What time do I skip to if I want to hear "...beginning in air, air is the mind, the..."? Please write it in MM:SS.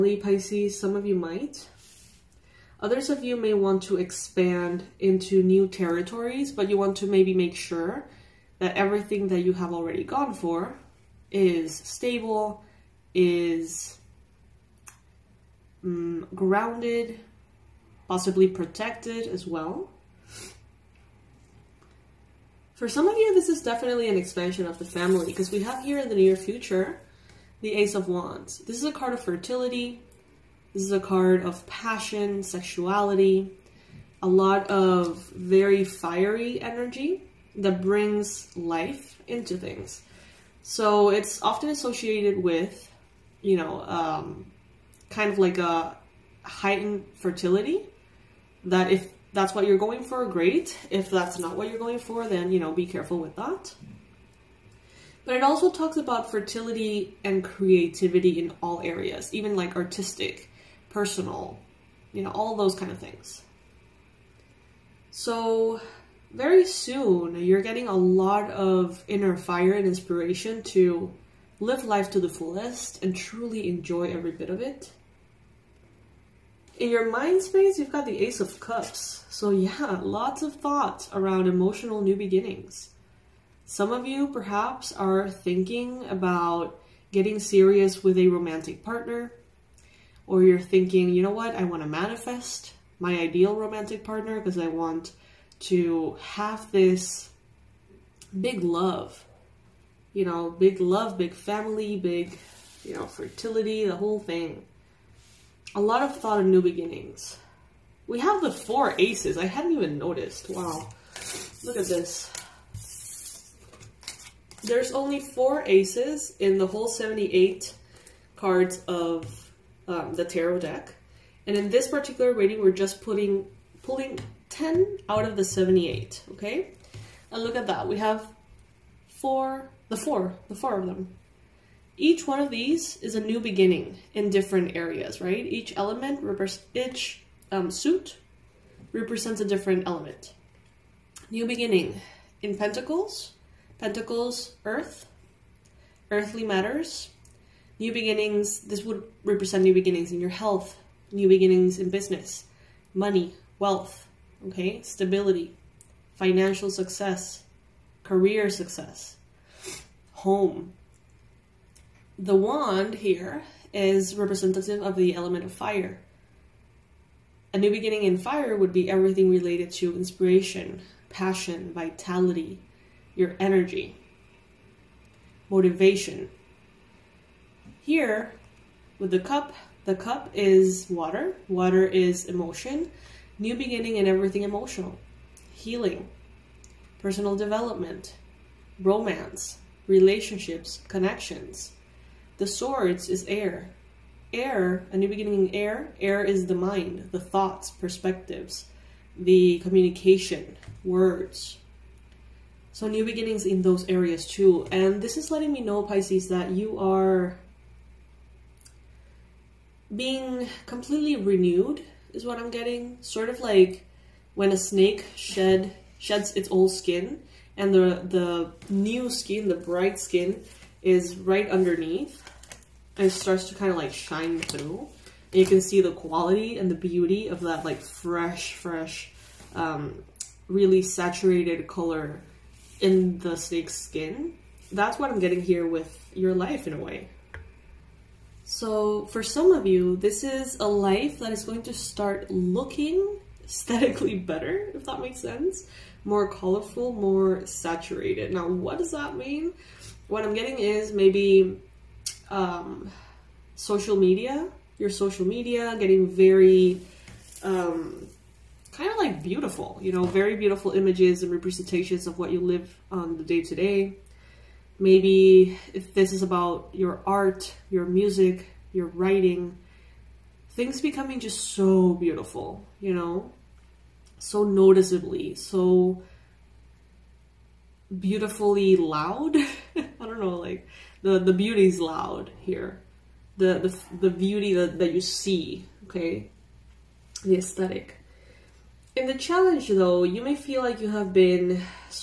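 03:15.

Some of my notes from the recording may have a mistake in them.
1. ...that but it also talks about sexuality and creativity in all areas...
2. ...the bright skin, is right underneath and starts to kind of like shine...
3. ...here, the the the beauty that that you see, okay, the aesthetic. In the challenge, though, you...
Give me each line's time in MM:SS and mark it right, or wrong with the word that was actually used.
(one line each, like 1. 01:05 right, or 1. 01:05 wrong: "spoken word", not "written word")
1. 00:53 wrong: "fertility", not "sexuality"
2. 03:39 right
3. 04:42 right.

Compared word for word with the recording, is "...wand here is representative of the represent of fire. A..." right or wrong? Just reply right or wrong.
wrong.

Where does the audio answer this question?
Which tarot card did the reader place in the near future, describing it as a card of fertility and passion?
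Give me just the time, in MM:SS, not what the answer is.
00:27.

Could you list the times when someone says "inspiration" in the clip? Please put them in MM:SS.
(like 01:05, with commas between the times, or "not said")
01:09, 02:49.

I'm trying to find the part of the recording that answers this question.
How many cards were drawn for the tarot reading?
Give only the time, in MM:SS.
02:04.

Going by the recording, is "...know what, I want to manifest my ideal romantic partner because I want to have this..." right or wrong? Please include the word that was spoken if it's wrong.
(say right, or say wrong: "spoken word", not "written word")
right.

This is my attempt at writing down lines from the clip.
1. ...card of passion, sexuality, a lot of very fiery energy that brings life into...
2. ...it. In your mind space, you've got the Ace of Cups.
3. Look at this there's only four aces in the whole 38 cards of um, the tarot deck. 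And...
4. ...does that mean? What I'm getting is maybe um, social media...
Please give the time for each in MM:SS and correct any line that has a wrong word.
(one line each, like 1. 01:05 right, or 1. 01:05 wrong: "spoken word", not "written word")
1. 00:30 right
2. 01:14 right
3. 01:51 wrong: "78", not "38"
4. 04:08 right.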